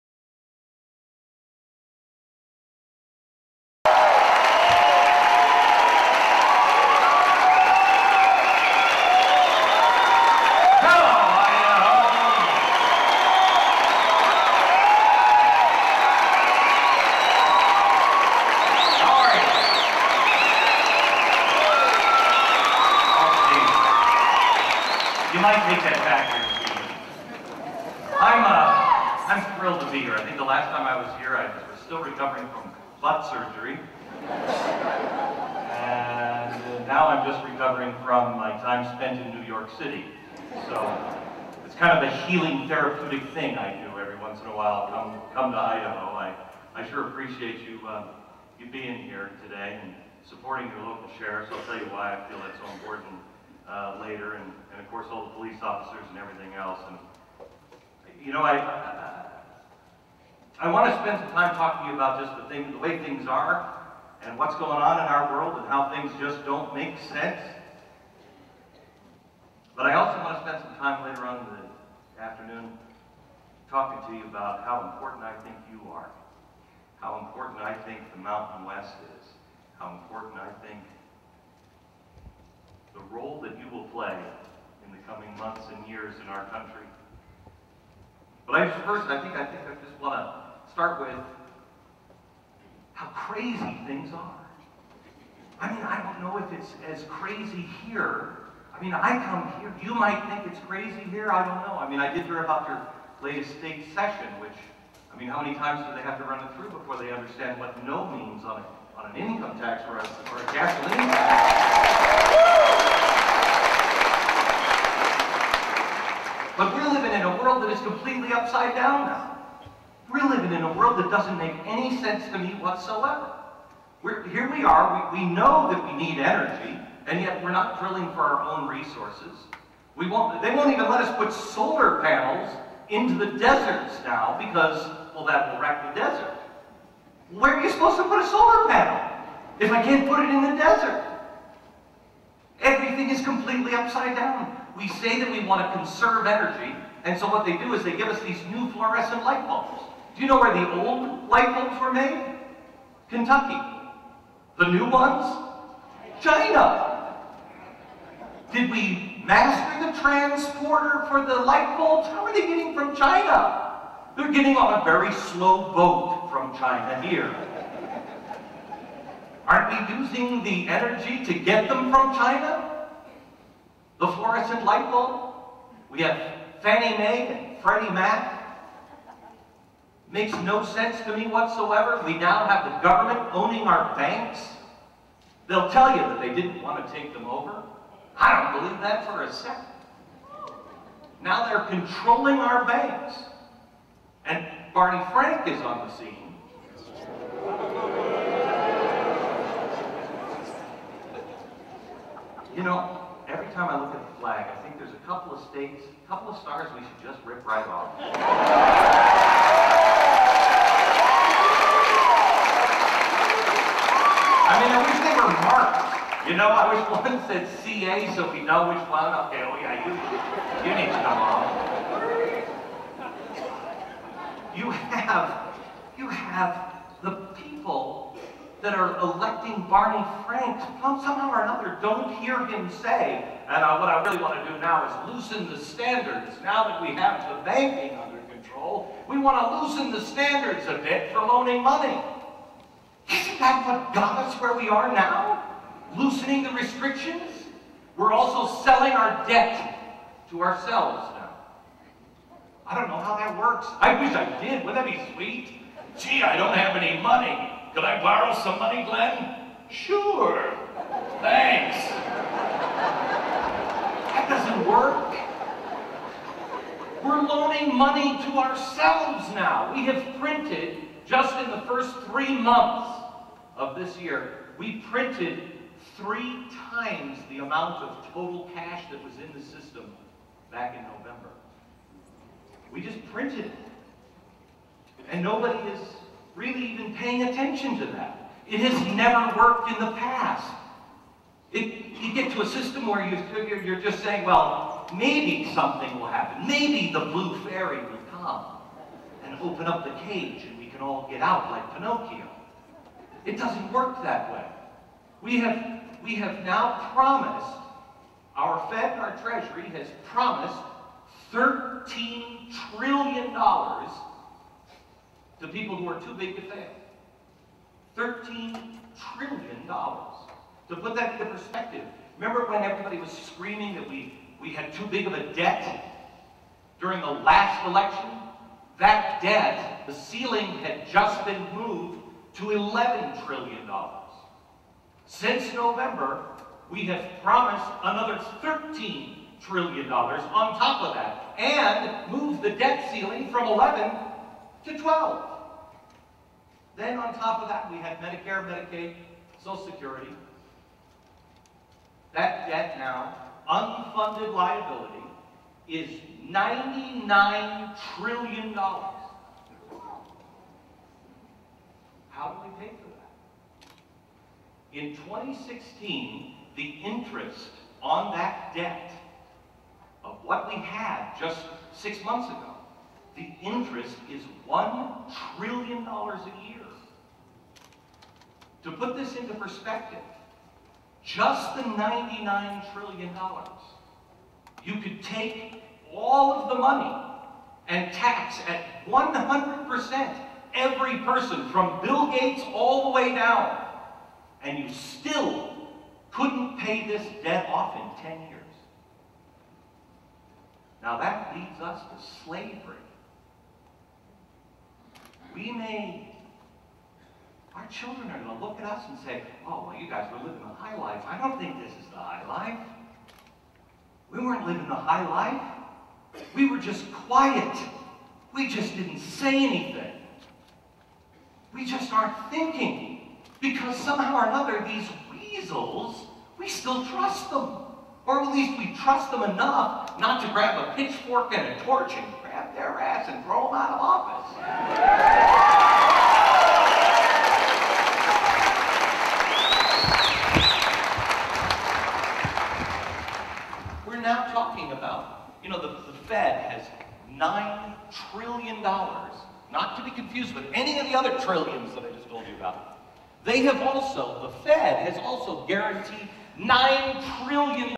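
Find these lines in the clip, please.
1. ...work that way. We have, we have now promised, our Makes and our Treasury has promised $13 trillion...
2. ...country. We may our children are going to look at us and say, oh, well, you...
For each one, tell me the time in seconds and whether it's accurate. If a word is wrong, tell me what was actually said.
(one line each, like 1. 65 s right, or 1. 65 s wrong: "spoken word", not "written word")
1. 303 s wrong: "Fed", not "Makes"
2. 402 s wrong: "slavery", not "country".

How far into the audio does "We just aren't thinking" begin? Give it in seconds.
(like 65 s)
421 s.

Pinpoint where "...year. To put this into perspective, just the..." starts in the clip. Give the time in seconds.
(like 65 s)
376 s.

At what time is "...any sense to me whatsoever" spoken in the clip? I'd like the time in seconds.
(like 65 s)
121 s.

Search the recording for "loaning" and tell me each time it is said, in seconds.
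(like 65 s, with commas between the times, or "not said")
241 s, 267 s.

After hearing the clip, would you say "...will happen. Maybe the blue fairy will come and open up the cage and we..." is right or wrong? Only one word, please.
right.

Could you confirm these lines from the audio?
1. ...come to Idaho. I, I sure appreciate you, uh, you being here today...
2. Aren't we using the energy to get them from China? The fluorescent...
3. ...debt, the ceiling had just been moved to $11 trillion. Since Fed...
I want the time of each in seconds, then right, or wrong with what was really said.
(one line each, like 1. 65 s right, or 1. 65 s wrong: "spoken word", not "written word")
1. 45 s right
2. 169 s right
3. 329 s wrong: "November", not "Fed".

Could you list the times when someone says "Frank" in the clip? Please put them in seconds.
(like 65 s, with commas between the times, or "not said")
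195 s, 230 s.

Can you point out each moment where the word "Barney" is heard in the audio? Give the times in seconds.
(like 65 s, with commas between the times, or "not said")
194 s, 229 s.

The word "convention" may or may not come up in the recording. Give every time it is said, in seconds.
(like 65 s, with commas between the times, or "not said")
not said.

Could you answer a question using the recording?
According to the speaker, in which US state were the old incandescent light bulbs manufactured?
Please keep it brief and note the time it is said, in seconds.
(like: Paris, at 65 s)
Kentucky, at 153 s.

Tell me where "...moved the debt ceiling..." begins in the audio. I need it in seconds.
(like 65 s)
342 s.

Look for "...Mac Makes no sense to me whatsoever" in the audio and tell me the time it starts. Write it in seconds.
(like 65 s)
177 s.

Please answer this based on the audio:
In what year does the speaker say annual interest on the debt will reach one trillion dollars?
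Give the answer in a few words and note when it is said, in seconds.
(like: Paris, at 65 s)
2016, at 364 s.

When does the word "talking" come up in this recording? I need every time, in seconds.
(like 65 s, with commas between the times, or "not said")
61 s, 73 s, 444 s.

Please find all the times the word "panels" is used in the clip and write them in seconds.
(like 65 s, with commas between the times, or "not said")
132 s, 138 s.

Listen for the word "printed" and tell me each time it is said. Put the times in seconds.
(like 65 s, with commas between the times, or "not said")
270 s, 274 s, 283 s.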